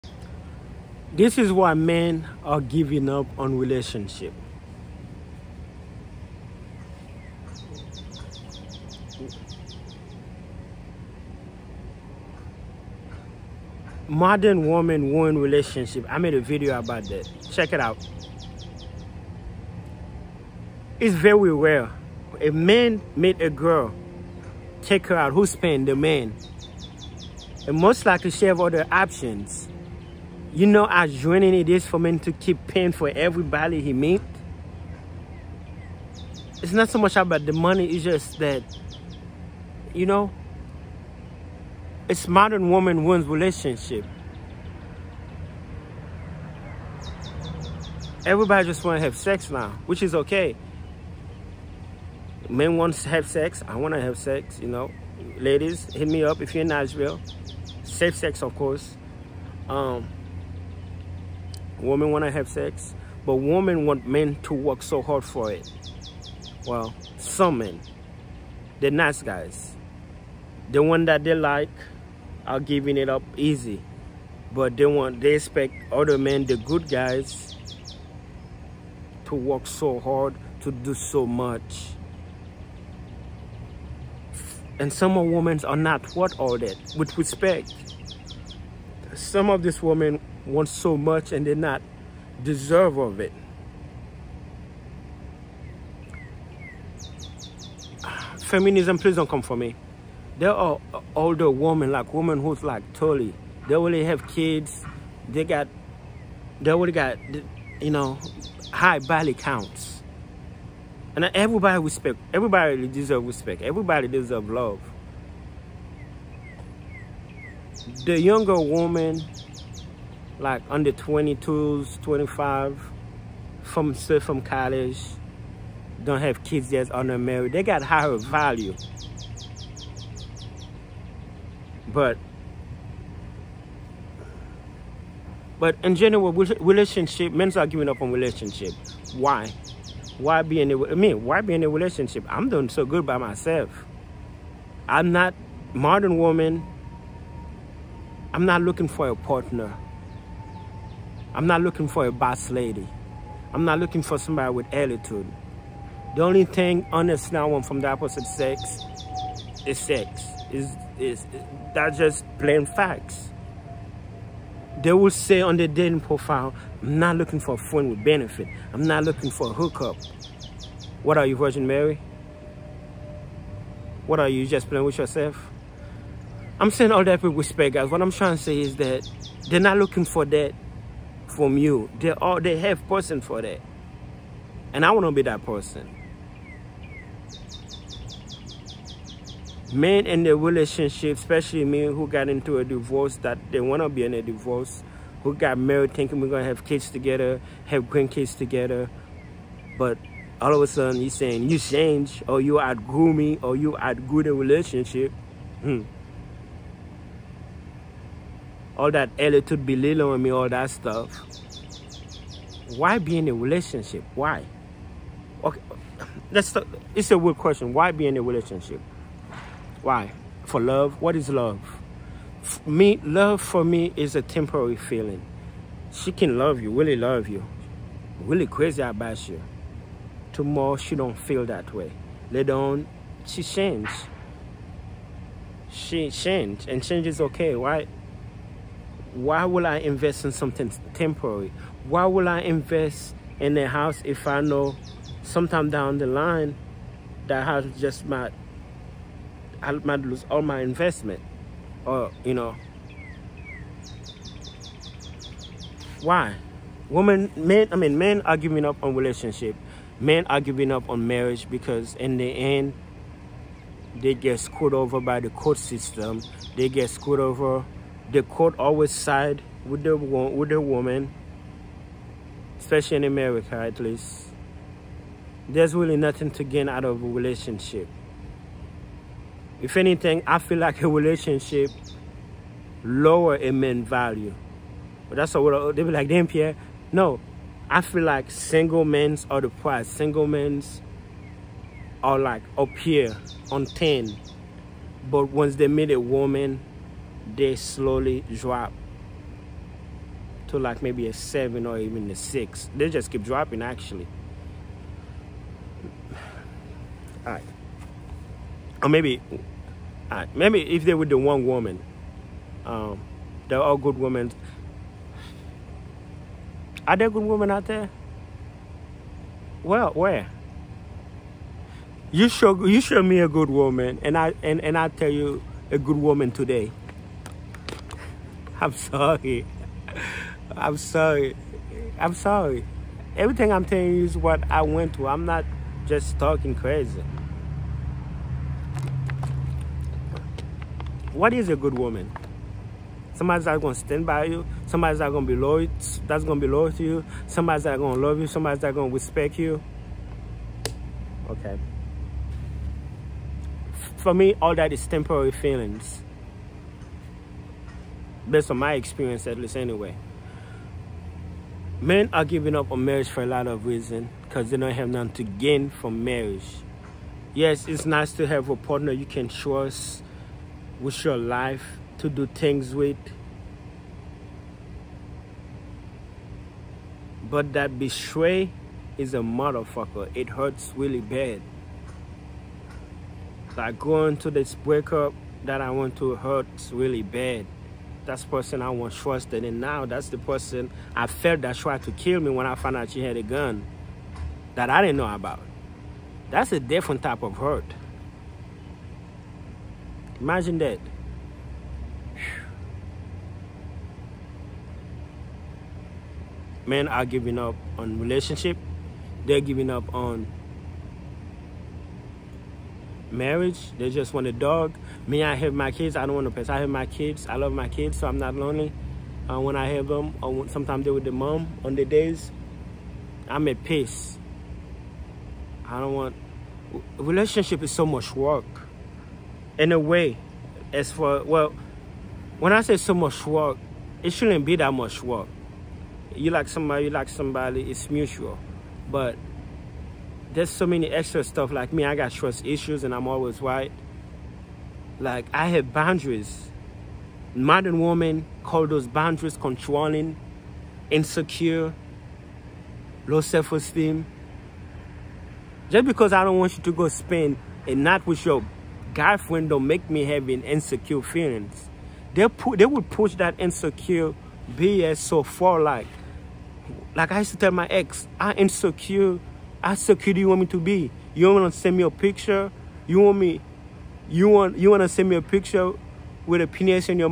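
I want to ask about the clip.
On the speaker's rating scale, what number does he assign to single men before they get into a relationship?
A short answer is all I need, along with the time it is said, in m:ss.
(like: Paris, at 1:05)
10, at 4:53.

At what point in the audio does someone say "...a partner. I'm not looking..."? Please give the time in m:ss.
2:29.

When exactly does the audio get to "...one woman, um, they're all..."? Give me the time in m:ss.
5:11.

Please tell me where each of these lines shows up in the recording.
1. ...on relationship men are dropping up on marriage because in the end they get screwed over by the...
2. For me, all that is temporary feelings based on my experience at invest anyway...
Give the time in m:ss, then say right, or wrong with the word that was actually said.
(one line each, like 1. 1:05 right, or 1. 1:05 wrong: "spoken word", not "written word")
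1. 4:18 wrong: "giving", not "dropping"
2. 5:53 wrong: "least", not "invest".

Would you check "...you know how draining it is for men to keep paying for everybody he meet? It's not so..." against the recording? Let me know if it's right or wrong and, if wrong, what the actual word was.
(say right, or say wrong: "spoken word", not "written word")
right.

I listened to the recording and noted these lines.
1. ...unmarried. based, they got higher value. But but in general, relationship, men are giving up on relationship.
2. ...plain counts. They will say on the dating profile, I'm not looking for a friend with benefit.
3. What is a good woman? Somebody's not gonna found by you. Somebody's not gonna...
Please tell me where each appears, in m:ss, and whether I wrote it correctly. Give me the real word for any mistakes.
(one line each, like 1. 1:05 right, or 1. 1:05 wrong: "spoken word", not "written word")
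1. 2:06 wrong: "married", not "based"
2. 2:42 wrong: "facts", not "counts"
3. 5:41 wrong: "stand", not "found".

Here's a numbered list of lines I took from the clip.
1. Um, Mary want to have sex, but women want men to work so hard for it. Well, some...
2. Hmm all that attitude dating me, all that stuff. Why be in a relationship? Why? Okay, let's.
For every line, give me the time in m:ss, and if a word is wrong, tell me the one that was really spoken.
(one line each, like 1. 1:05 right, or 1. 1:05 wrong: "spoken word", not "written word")
1. 0:59 wrong: "Women", not "Mary"
2. 3:25 wrong: "belittling", not "dating".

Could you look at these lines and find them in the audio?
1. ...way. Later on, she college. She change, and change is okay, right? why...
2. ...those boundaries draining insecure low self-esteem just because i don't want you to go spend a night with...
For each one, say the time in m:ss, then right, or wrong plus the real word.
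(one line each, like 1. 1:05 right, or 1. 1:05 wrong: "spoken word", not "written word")
1. 3:51 wrong: "change", not "college"
2. 7:28 wrong: "controlling", not "draining".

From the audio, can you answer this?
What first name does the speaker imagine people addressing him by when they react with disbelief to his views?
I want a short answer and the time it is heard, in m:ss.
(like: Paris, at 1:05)
Pierre, at 4:46.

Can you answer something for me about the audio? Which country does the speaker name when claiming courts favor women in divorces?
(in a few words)
America.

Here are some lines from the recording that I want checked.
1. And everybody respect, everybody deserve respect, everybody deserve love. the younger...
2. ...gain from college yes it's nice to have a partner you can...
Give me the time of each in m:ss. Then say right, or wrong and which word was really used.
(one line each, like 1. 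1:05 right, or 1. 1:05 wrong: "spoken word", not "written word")
1. 1:51 right
2. 6:05 wrong: "marriage", not "college".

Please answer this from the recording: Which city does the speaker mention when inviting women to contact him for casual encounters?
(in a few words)
Nashville.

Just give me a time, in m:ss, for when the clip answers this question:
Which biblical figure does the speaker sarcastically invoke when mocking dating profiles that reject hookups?
2:51.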